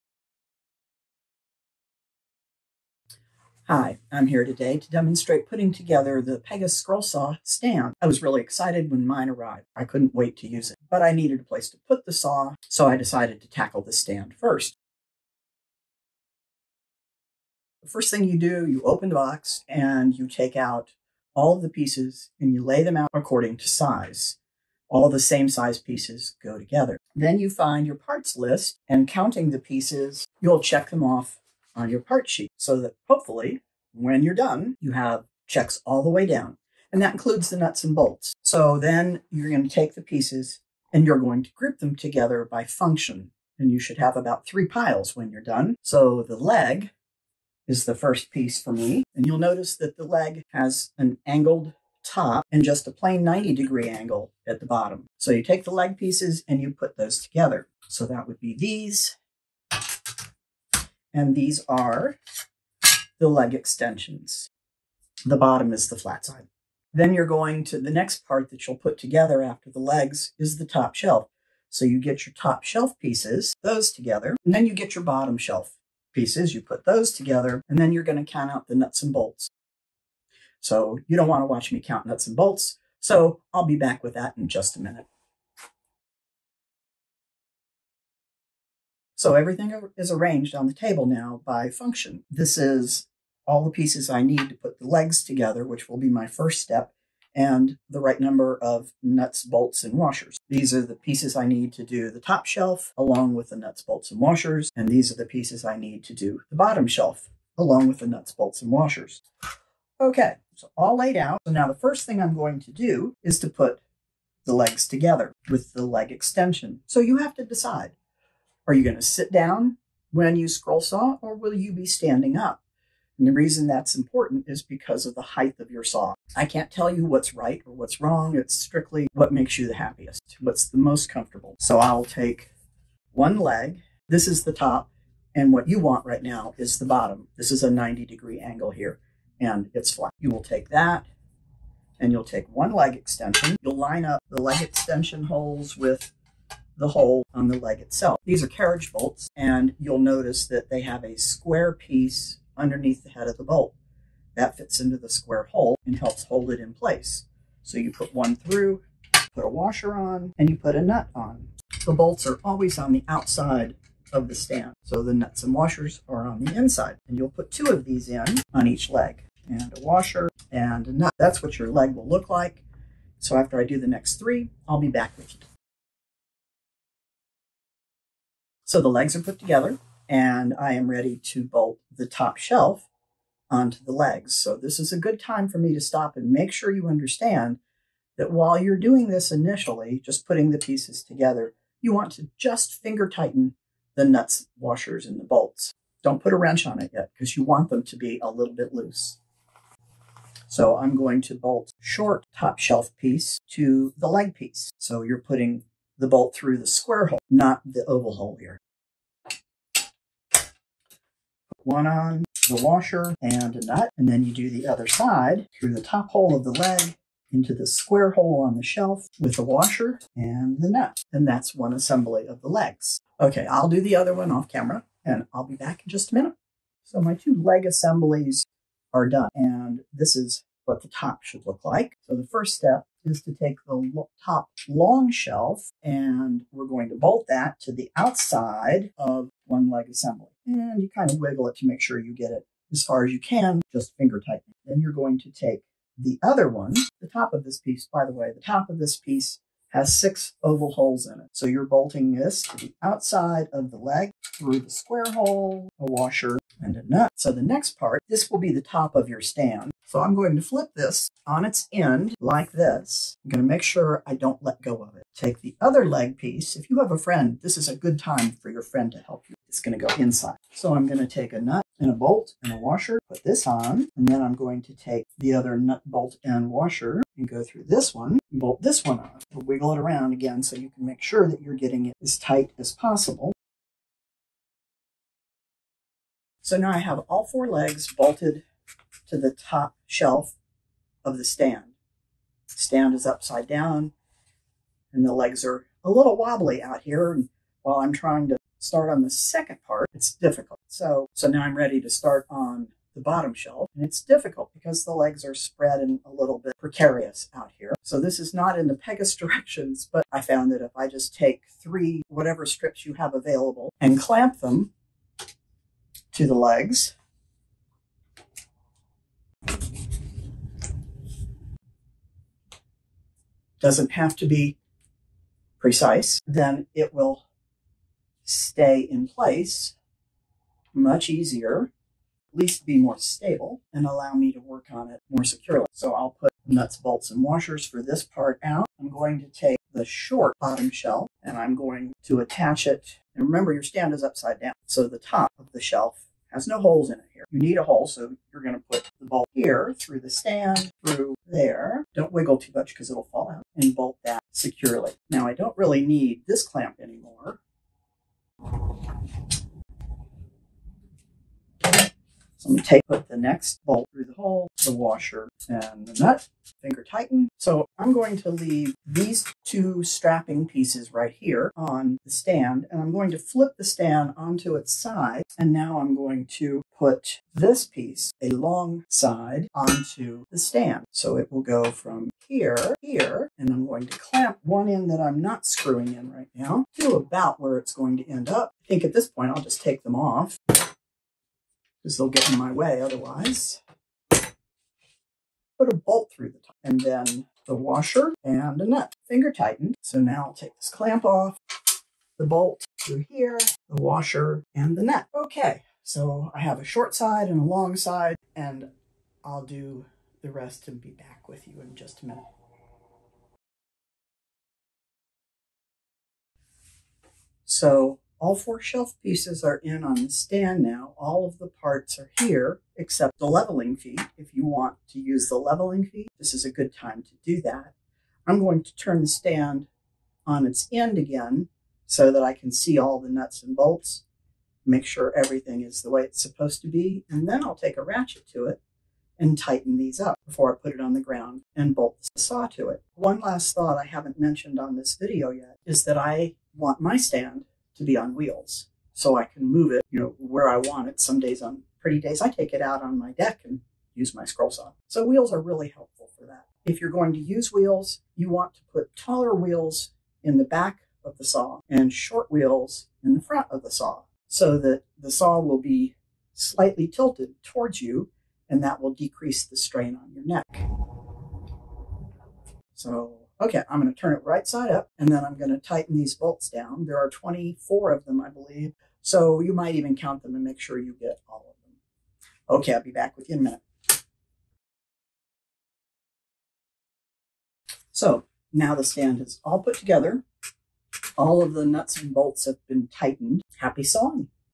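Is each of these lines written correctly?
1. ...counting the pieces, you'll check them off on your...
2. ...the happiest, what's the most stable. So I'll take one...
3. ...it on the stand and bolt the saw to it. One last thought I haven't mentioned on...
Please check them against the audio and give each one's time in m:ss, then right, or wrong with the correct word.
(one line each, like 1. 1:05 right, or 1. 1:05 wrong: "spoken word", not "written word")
1. 0:29 right
2. 2:09 wrong: "comfortable", not "stable"
3. 7:20 wrong: "ground", not "stand".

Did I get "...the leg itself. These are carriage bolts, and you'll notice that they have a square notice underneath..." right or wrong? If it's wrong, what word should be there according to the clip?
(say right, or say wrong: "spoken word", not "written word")
wrong: "piece", not "notice".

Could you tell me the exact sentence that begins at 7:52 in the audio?
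So okay, I'm going to turn it right side up and then I'm going to tighten these bolts down.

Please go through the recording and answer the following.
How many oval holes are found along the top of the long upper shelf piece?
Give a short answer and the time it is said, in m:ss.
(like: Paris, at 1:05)
6, at 4:09.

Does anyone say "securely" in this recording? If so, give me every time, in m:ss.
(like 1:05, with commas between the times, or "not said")
5:35, 5:54.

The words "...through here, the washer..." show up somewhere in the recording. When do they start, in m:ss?
6:42.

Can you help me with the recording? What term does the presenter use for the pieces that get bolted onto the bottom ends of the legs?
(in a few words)
Leg extensions.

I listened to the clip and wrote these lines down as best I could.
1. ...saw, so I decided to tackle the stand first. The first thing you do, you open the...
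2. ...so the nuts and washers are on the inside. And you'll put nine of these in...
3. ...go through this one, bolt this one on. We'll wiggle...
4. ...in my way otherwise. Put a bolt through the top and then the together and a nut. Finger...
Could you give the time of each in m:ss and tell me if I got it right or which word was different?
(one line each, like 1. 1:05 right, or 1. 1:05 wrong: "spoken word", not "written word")
1. 0:12 right
2. 2:44 wrong: "two", not "nine"
3. 4:37 right
4. 6:32 wrong: "washer", not "together".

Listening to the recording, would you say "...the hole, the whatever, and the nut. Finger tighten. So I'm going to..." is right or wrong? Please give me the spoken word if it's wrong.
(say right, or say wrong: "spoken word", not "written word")
wrong: "washer", not "whatever".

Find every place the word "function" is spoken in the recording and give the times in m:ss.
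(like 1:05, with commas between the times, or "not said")
0:42, 1:31.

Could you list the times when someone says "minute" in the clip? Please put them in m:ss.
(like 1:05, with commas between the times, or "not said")
1:24, 3:46, 6:52, 8:03.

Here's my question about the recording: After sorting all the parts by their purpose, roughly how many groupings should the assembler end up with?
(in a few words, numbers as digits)
3.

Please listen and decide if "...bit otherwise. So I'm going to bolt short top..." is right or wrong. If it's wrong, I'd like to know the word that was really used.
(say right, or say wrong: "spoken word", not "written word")
wrong: "loose", not "otherwise".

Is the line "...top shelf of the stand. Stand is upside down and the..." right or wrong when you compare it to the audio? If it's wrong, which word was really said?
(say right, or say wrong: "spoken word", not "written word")
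right.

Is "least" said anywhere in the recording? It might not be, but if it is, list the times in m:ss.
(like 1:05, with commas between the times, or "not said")
5:32.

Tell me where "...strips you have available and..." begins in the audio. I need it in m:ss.
5:12.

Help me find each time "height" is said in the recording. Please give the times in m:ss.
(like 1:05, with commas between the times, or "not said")
2:05.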